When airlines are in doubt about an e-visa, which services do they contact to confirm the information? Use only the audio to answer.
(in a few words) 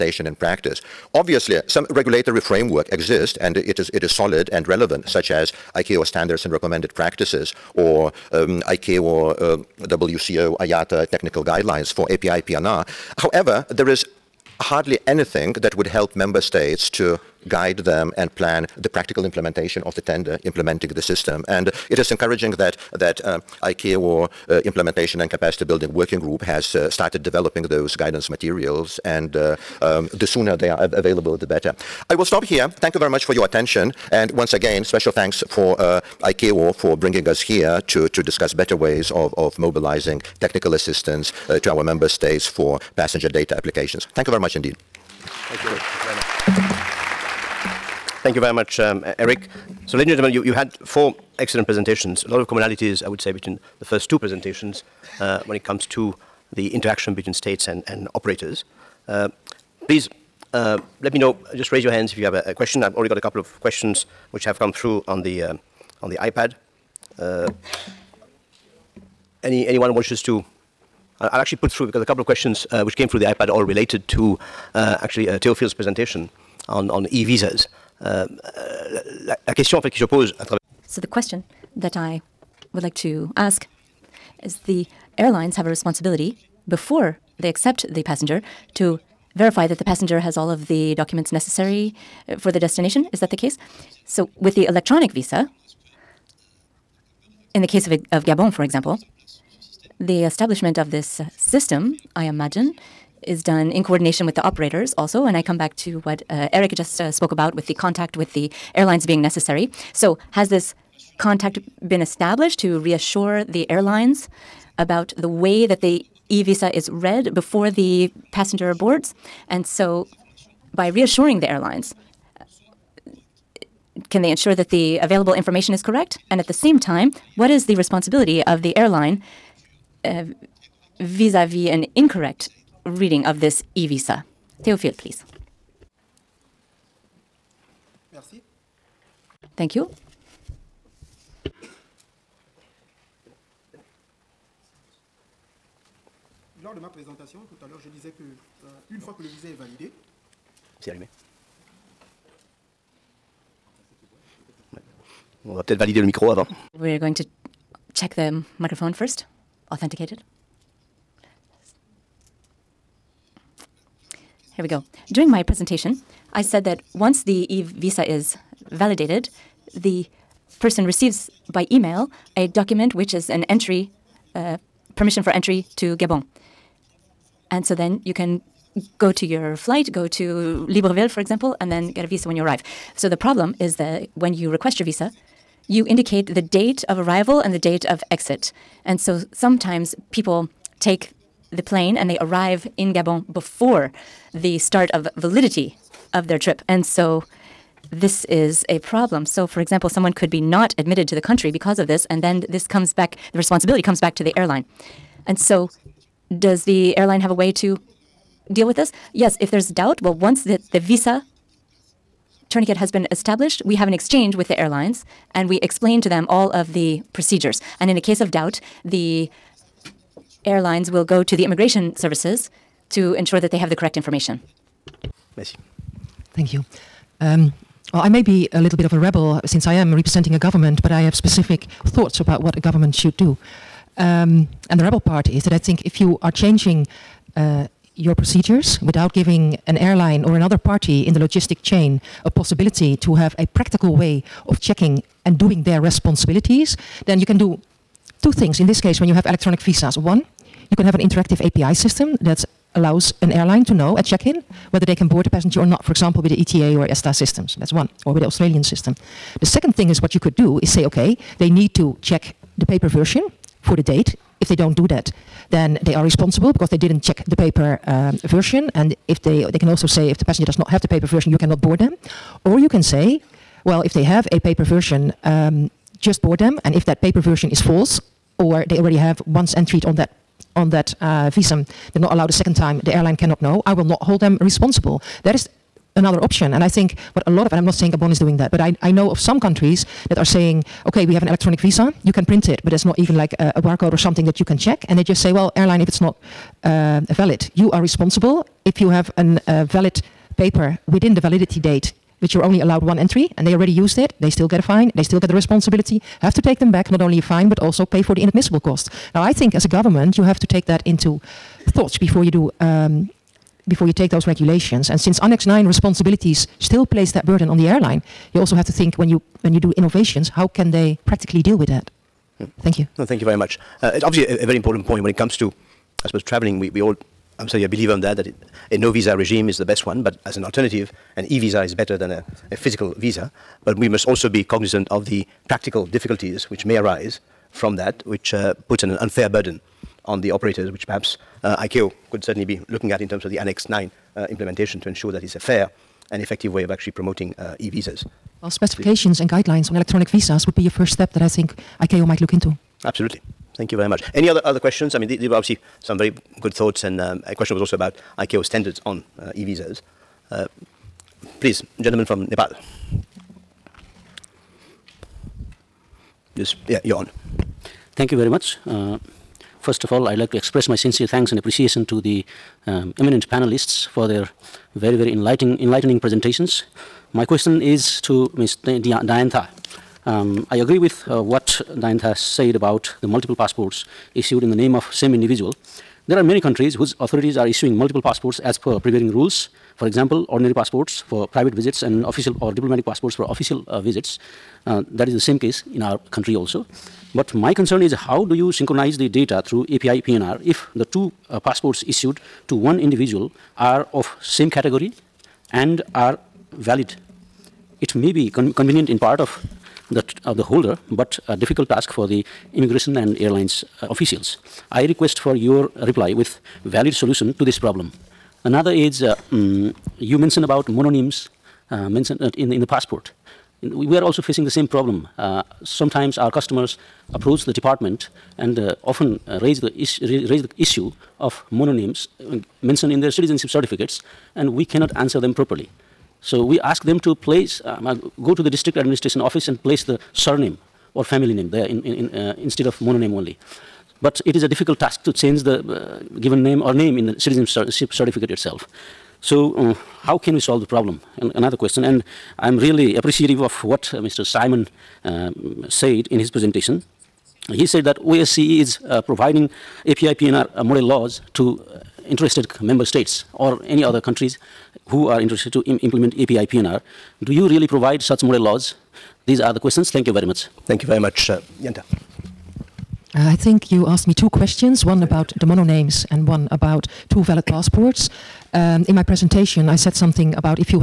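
Immigration services.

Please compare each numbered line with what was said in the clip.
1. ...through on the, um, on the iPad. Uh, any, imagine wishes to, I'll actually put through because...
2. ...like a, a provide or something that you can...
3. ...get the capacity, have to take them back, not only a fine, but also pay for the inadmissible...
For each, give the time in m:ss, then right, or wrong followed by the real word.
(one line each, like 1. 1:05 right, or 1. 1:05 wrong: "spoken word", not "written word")
1. 1:04 wrong: "anyone", not "imagine"
2. 4:53 wrong: "barcode", not "provide"
3. 5:05 wrong: "responsibility", not "capacity".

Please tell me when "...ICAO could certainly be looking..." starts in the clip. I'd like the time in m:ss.
5:41.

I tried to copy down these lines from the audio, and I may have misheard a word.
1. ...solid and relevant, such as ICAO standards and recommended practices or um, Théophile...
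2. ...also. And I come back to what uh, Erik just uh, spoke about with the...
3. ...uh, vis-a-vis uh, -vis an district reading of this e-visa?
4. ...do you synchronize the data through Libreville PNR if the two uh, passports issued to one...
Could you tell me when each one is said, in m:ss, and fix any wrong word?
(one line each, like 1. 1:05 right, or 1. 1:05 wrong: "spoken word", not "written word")
1. 0:04 wrong: "ICAO", not "Théophile"
2. 1:44 right
3. 2:10 wrong: "incorrect", not "district"
4. 6:38 wrong: "API", not "Libreville".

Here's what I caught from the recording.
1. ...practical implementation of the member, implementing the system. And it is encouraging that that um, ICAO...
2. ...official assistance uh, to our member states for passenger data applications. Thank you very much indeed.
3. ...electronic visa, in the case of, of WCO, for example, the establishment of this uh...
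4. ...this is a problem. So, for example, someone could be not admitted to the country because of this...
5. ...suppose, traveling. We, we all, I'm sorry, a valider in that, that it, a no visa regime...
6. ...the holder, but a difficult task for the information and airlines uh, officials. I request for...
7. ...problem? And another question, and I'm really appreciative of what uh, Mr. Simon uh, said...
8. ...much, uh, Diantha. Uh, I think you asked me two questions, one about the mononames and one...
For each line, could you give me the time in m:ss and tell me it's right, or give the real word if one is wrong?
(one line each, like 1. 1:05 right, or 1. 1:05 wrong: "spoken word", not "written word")
1. 0:18 wrong: "tender", not "member"
2. 0:40 wrong: "technical", not "official"
3. 1:34 wrong: "Gabon", not "WCO"
4. 3:17 right
5. 5:26 wrong: "believer", not "valider"
6. 6:50 wrong: "immigration", not "information"
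7. 7:30 right
8. 7:50 right.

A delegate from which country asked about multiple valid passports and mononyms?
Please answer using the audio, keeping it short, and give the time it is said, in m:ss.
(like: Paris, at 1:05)
Nepal, at 6:02.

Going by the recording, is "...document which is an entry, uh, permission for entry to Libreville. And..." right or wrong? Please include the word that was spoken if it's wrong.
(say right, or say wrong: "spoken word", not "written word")
wrong: "Gabon", not "Libreville".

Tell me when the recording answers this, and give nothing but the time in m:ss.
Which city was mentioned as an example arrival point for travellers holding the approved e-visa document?
3:00.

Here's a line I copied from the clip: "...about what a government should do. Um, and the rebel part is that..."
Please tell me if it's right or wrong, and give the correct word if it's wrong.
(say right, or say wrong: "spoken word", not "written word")
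right.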